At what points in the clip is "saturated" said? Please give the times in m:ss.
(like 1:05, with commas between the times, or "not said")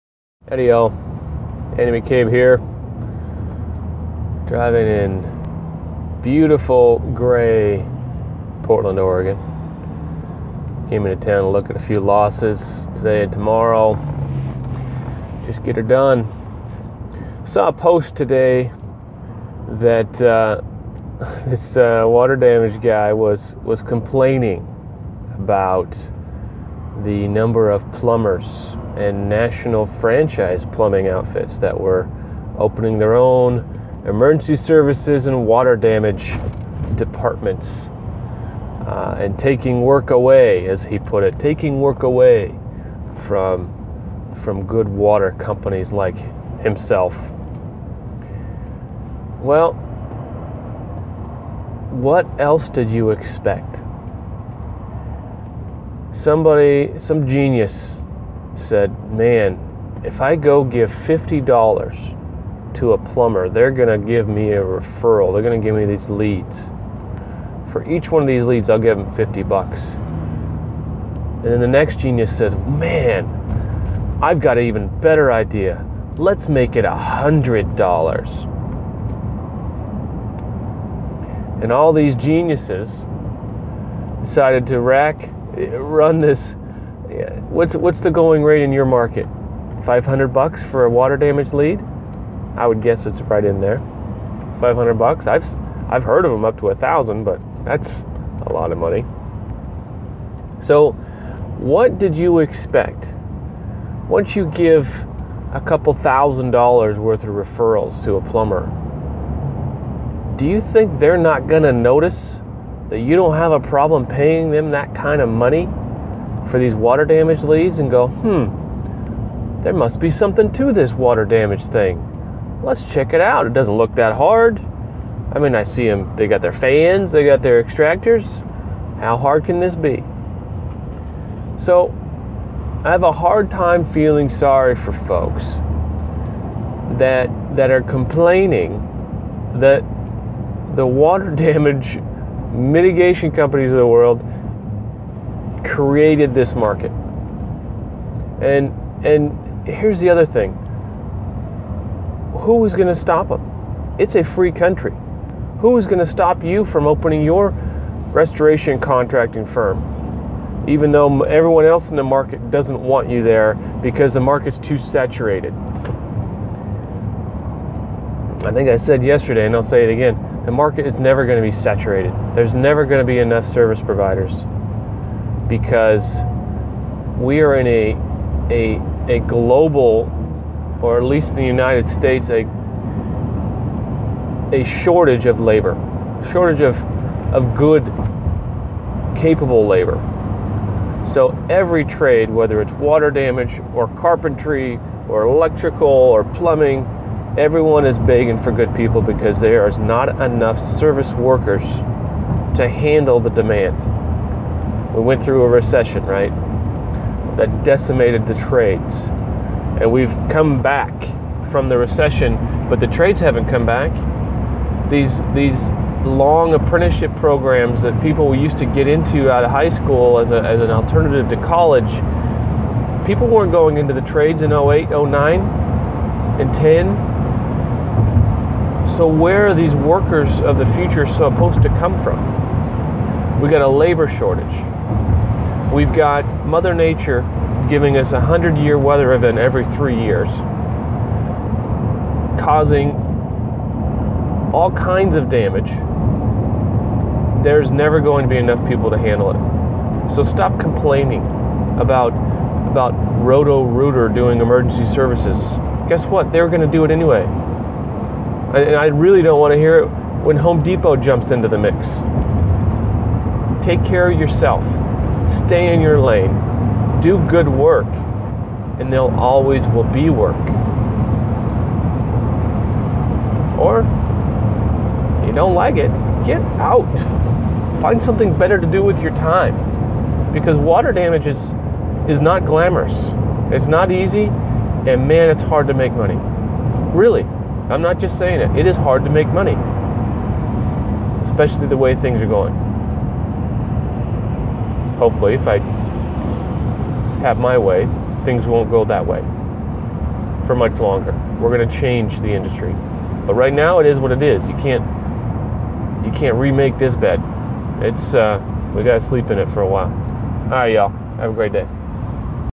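2:44, 2:51.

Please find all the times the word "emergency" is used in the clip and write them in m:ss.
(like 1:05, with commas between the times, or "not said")
0:34, 4:14.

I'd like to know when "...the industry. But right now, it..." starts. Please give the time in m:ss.
5:02.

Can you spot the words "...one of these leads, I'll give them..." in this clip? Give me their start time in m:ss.
1:08.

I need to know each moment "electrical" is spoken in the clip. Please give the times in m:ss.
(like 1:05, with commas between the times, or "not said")
3:15.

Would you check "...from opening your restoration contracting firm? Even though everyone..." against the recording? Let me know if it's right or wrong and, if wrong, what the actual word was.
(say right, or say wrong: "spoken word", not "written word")
right.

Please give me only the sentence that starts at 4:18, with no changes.
And I really don't want to hear it when Home Depot jumps into the mix.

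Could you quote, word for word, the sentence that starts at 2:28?
And and here's the other thing.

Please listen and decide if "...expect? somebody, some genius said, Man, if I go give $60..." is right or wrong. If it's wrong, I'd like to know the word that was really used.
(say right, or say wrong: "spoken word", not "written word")
wrong: "50", not "60".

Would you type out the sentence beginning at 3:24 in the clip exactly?
We went through a recession, right?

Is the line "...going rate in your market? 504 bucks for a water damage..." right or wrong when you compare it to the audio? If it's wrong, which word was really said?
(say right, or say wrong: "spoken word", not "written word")
wrong: "500", not "504".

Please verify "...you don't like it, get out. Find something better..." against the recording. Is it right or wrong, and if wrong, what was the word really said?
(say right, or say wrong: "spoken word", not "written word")
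right.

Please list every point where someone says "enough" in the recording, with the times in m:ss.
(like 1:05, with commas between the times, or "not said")
2:53, 3:20, 4:08.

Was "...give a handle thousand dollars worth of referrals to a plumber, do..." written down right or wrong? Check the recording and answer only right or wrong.
wrong.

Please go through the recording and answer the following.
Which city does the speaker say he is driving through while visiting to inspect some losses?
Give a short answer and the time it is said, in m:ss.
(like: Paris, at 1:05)
Portland, Oregon, at 0:08.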